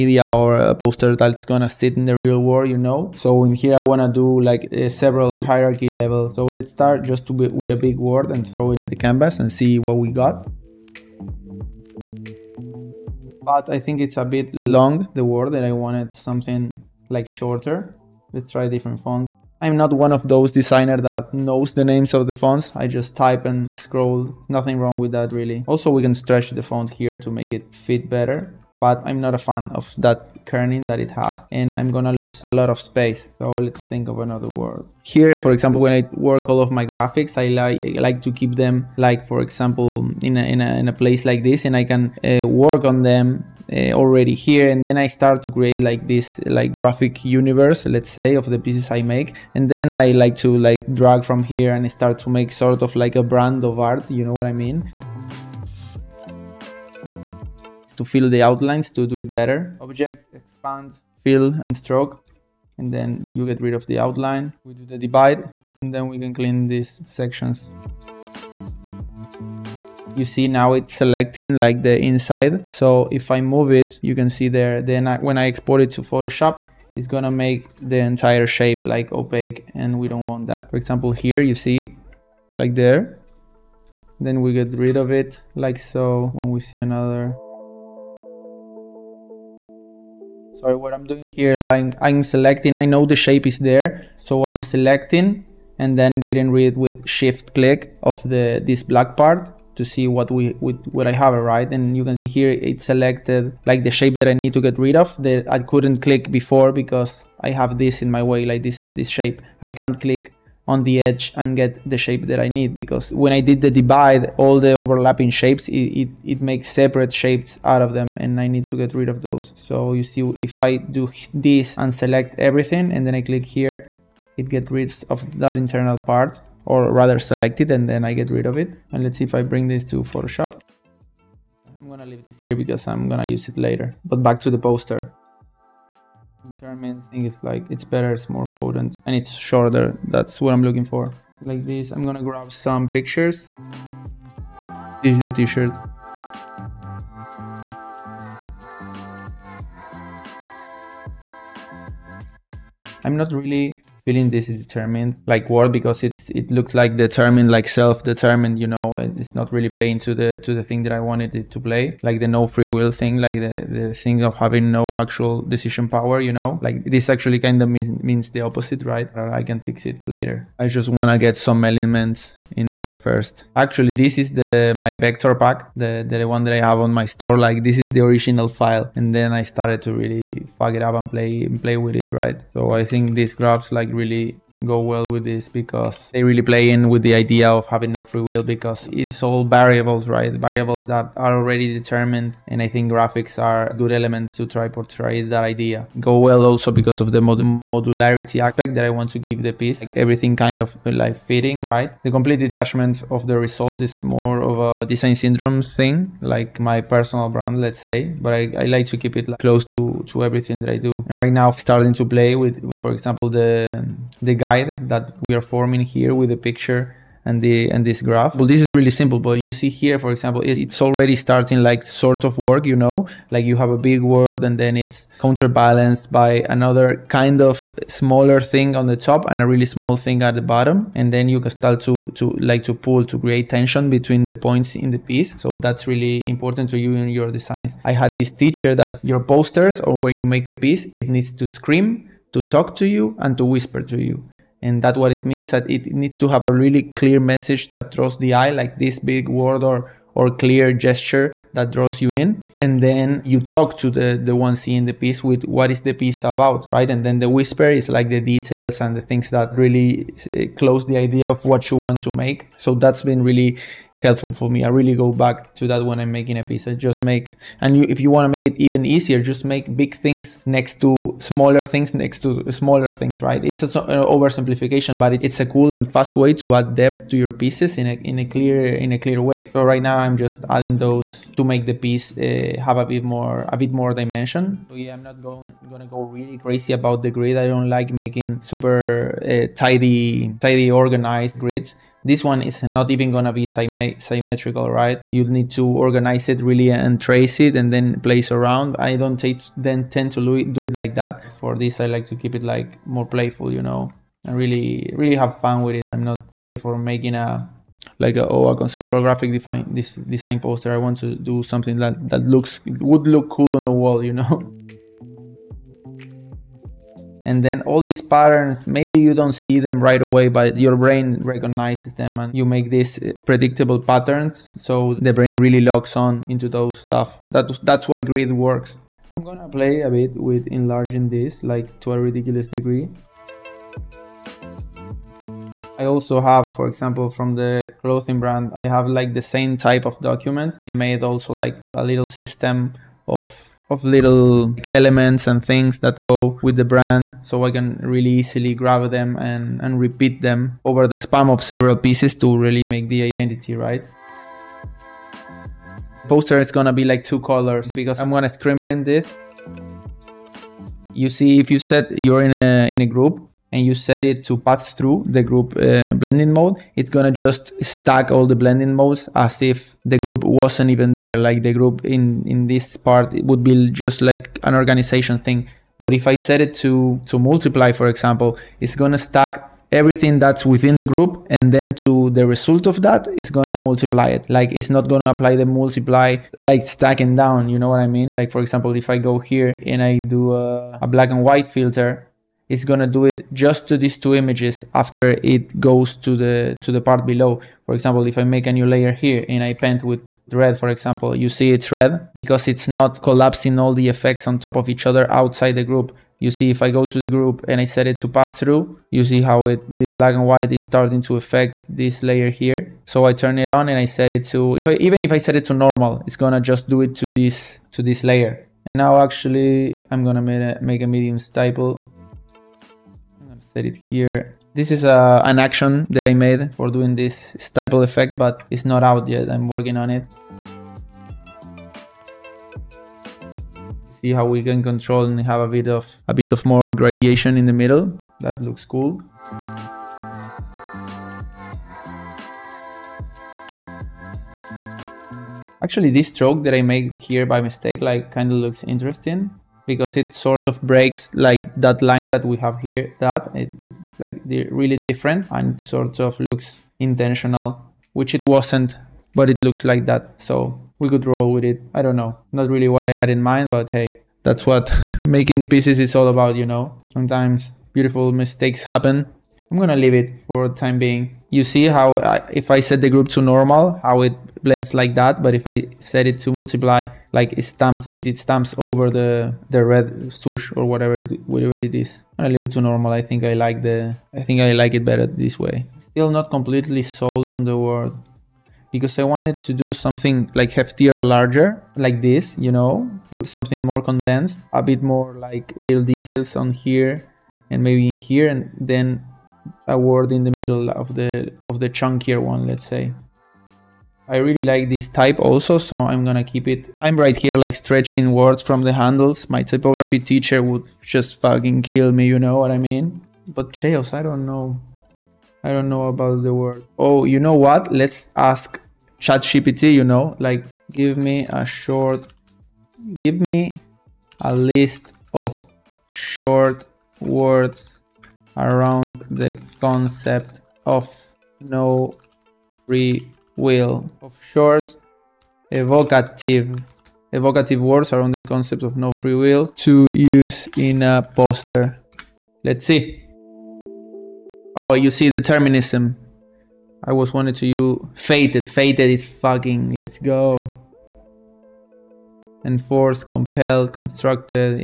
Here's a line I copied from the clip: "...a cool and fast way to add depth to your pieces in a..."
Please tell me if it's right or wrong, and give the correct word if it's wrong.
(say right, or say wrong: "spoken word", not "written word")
right.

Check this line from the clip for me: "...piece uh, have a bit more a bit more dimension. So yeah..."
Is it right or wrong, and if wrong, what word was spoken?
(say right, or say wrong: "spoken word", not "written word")
right.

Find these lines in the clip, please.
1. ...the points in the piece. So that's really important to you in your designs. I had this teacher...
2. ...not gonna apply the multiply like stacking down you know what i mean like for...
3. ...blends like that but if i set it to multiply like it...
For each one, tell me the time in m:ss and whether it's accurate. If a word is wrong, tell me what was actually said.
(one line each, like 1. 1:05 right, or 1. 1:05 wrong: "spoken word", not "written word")
1. 3:54 right
2. 6:24 right
3. 7:54 right.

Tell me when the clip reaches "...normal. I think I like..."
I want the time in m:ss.
8:02.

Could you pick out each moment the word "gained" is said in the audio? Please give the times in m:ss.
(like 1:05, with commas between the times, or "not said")
not said.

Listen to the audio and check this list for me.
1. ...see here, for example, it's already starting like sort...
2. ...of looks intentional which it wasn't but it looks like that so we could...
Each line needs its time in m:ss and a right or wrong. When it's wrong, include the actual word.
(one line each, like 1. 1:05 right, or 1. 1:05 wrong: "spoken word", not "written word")
1. 3:39 right
2. 7:35 right.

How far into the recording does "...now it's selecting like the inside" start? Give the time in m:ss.
1:10.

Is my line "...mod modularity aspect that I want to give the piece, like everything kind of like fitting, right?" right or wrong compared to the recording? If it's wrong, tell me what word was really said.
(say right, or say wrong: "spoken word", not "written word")
right.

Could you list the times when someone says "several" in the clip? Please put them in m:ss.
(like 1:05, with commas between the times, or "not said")
0:04, 5:51.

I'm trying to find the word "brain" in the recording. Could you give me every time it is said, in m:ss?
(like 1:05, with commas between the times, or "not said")
5:20, 5:25.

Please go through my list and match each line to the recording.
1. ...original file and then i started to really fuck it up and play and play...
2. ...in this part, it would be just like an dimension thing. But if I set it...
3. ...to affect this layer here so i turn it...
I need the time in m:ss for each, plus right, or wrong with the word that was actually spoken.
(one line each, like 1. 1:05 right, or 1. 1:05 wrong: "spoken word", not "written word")
1. 2:57 right
2. 6:12 wrong: "organization", not "dimension"
3. 6:51 right.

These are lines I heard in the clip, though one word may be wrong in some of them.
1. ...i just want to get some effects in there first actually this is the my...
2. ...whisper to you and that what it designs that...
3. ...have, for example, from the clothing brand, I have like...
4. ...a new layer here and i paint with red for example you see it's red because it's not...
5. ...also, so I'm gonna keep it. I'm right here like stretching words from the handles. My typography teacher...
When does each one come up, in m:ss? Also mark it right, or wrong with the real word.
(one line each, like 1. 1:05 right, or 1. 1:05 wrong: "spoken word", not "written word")
1. 2:50 wrong: "elements", not "effects"
2. 4:03 wrong: "means", not "designs"
3. 5:36 right
4. 6:38 right
5. 8:25 right.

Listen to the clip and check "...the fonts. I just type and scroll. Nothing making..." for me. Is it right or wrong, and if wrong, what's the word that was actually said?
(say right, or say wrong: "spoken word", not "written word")
wrong: "wrong", not "making".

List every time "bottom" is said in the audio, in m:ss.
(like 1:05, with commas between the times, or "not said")
3:50.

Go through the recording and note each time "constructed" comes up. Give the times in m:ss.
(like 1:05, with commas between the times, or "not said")
9:13.